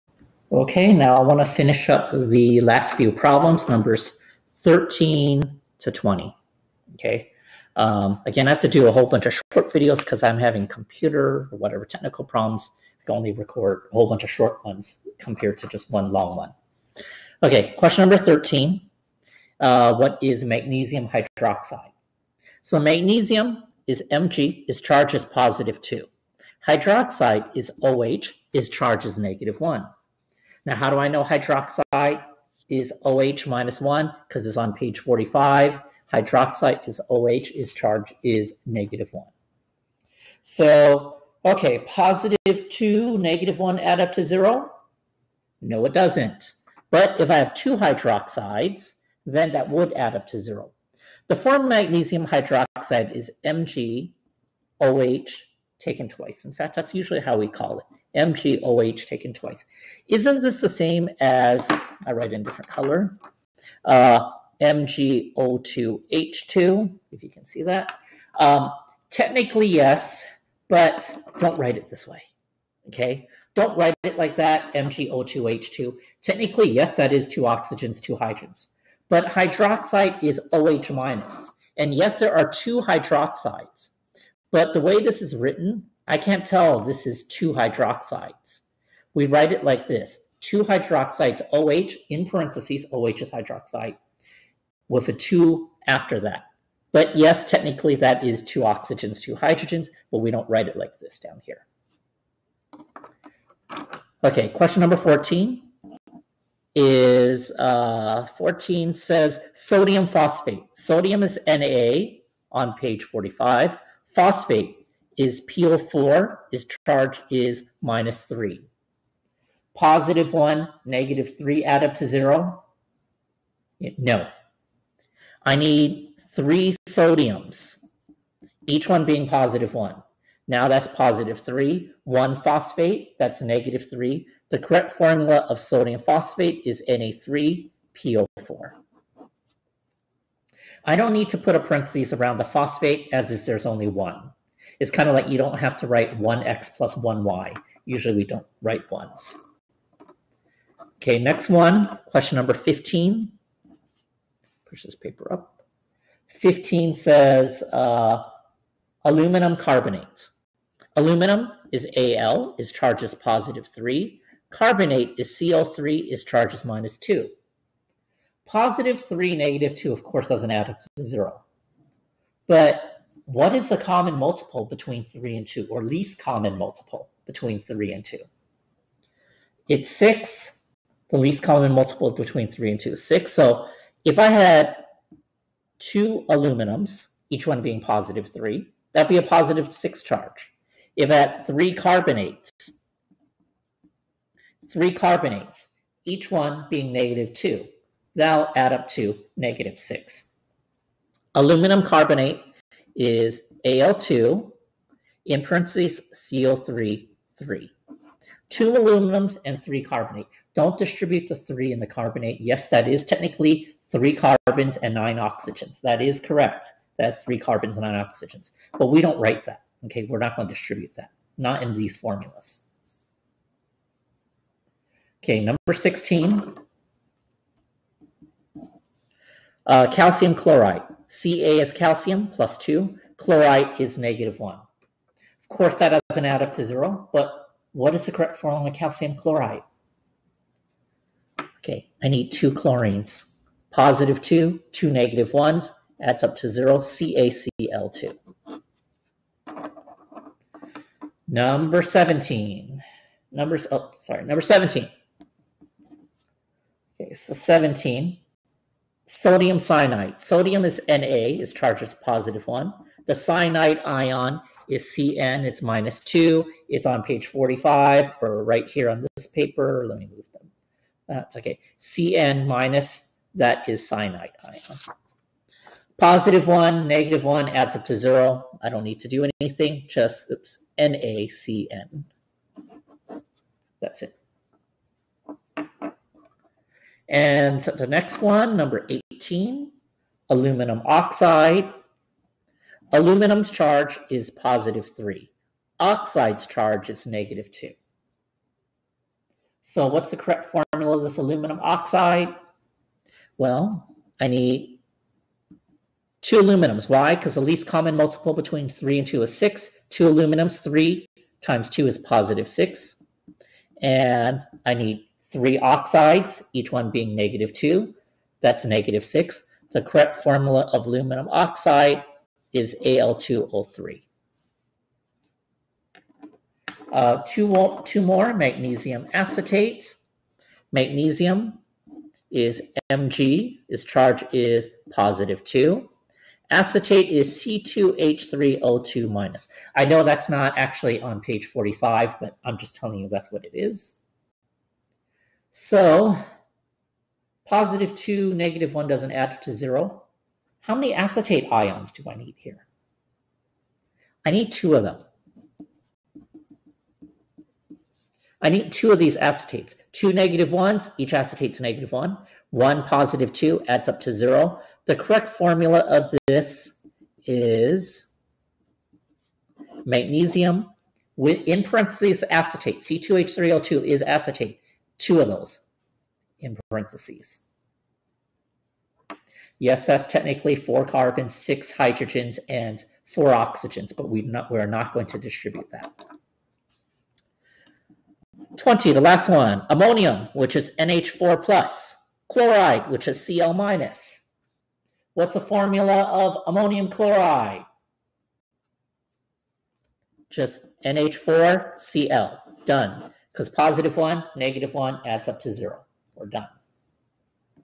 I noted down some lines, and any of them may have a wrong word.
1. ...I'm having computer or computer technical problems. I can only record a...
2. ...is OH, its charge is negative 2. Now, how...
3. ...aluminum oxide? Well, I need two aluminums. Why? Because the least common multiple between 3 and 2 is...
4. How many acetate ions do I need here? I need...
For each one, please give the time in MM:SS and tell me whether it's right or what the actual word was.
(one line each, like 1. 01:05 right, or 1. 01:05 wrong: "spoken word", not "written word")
1. 00:10 wrong: "whatever", not "computer"
2. 00:27 wrong: "1", not "2"
3. 05:01 right
4. 05:50 right.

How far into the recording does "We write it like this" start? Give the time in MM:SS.
01:29.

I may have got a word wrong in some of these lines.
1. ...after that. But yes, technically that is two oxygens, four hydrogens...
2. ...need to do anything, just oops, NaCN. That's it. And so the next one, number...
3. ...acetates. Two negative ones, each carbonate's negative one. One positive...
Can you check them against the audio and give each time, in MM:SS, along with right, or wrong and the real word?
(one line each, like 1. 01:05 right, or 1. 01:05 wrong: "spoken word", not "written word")
1. 01:35 wrong: "two", not "four"
2. 04:38 right
3. 05:59 wrong: "acetate", not "carbonate".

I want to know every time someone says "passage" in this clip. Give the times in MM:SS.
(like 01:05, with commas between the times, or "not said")
not said.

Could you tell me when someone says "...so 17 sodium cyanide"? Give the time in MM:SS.
04:17.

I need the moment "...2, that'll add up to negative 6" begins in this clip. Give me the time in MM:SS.
03:17.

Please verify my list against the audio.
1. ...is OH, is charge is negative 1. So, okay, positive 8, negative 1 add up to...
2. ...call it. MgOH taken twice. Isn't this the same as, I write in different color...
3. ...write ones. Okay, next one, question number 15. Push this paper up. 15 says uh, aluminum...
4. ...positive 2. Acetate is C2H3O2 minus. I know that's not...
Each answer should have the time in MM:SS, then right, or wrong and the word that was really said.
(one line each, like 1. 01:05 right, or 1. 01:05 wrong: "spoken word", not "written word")
1. 00:36 wrong: "2", not "8"
2. 00:57 right
3. 02:28 right
4. 05:34 right.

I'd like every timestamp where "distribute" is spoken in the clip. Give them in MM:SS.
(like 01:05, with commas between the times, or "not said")
03:30, 03:40, 06:25.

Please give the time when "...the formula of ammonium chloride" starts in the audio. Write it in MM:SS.
06:35.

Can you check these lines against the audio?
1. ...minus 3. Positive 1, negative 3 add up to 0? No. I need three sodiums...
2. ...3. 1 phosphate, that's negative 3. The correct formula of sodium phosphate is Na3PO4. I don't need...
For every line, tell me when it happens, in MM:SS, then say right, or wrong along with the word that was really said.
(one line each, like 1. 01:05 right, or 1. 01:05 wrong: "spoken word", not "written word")
1. 01:57 right
2. 02:11 right.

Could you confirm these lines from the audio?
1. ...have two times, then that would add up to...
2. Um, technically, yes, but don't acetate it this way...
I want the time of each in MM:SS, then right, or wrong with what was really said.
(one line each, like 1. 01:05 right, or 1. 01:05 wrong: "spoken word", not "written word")
1. 00:47 wrong: "hydroxides", not "times"
2. 01:08 wrong: "write", not "acetate".